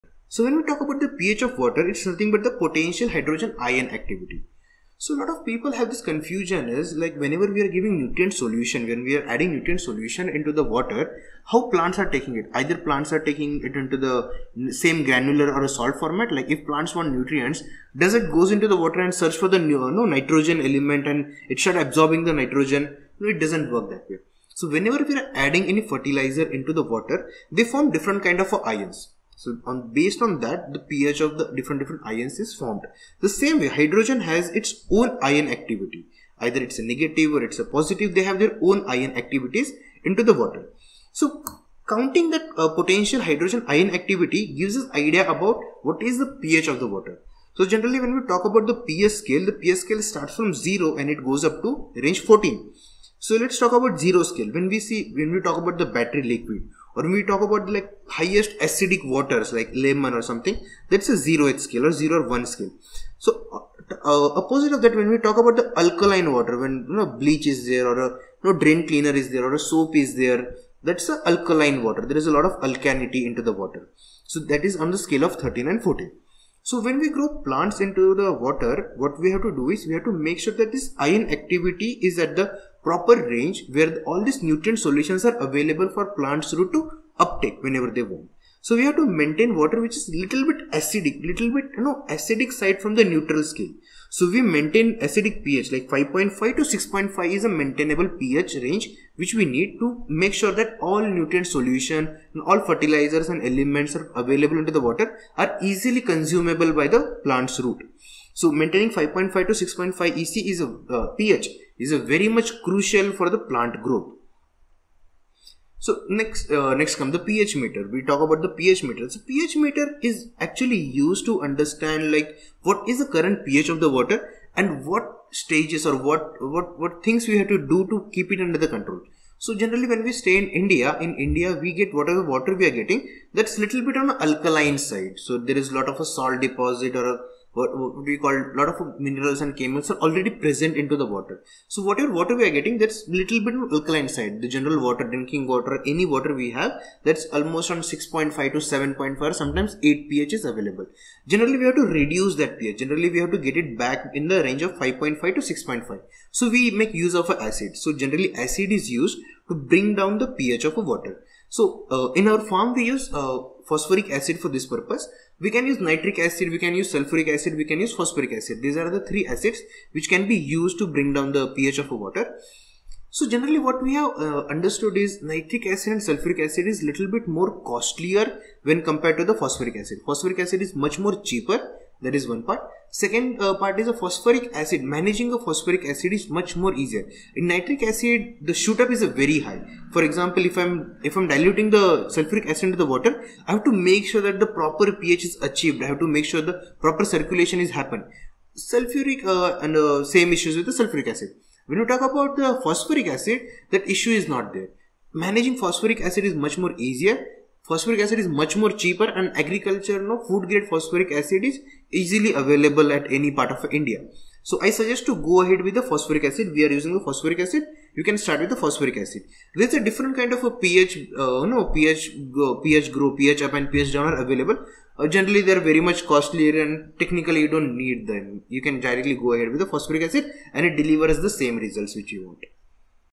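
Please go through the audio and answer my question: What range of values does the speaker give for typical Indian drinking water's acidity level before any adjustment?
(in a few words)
6.5 to 7.5.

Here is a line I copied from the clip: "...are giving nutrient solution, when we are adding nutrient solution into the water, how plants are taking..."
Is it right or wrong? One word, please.
right.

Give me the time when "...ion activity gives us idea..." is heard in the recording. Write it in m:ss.
0:43.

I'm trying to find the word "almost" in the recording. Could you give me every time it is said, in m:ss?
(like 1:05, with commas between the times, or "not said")
2:27.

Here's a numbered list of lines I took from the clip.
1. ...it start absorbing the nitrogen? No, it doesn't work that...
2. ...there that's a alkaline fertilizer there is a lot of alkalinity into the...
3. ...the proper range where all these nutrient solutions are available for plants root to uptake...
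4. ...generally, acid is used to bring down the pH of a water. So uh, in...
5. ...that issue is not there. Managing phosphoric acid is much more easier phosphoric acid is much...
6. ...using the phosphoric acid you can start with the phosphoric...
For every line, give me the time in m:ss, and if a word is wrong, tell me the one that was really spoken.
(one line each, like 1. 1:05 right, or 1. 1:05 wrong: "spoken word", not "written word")
1. 0:21 right
2. 1:10 wrong: "water", not "fertilizer"
3. 1:22 right
4. 2:37 right
5. 3:23 right
6. 3:36 right.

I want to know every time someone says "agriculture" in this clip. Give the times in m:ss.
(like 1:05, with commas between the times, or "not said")
3:29.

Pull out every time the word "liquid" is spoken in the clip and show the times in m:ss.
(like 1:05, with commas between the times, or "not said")
0:56.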